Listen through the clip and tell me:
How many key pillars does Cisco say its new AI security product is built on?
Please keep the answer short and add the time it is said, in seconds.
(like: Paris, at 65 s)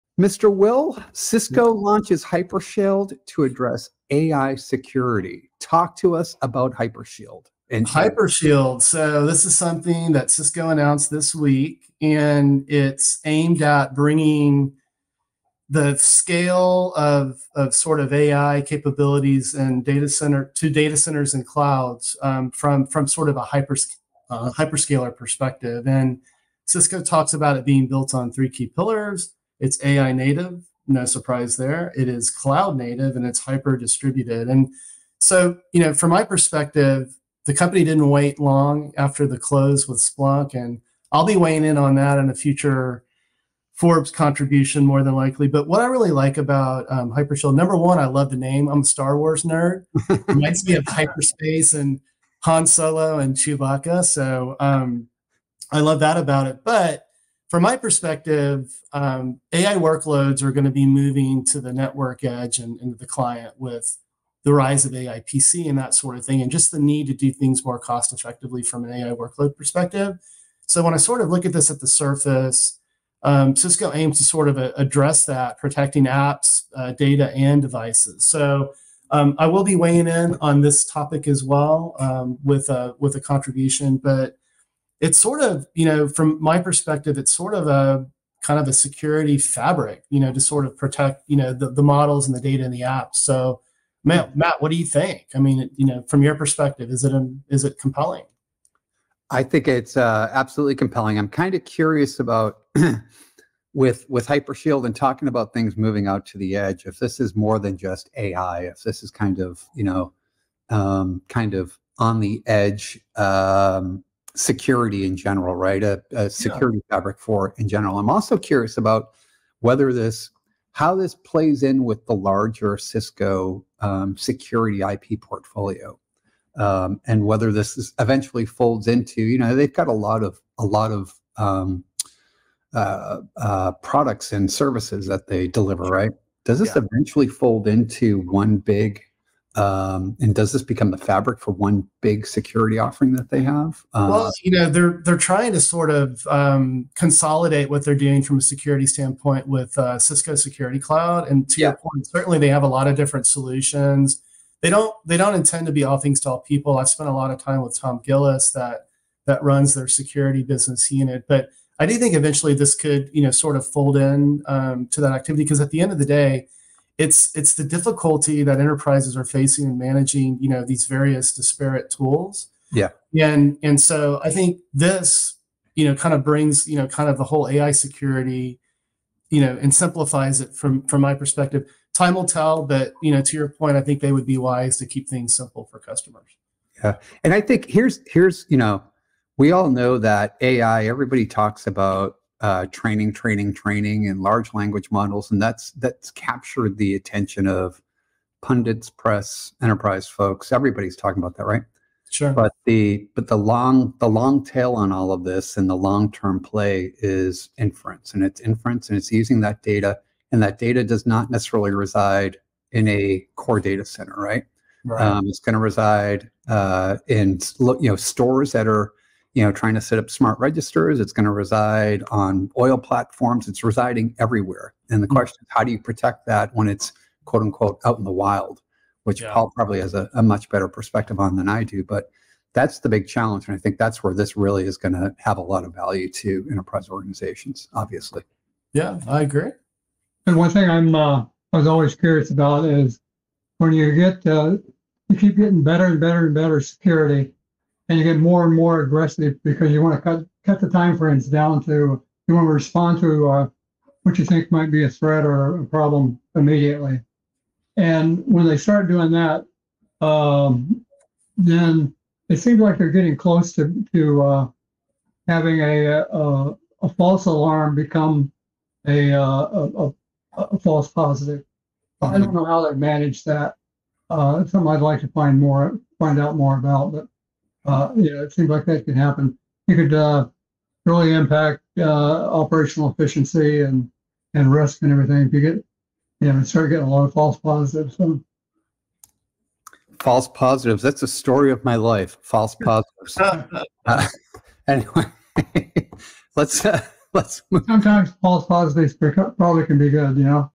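3, at 28 s.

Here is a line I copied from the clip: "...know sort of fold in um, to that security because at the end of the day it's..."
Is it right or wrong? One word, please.
wrong.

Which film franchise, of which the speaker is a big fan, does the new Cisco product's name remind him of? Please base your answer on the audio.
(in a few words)
Star Wars.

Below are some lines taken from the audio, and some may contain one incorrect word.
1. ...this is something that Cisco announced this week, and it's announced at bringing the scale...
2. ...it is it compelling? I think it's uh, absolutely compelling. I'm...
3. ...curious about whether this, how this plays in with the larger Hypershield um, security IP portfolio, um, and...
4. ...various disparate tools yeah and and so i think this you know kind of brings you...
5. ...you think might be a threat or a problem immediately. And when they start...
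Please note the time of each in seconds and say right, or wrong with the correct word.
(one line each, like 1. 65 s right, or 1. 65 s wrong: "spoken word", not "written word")
1. 9 s wrong: "aimed", not "announced"
2. 97 s right
3. 118 s wrong: "Cisco", not "Hypershield"
4. 170 s right
5. 254 s right.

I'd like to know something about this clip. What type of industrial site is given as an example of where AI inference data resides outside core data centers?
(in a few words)
Oil platforms.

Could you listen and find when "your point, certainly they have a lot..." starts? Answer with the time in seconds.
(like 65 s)
151 s.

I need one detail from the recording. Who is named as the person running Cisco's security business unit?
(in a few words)
Tom Gillis.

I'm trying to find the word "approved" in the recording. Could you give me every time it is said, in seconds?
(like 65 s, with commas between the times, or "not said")
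not said.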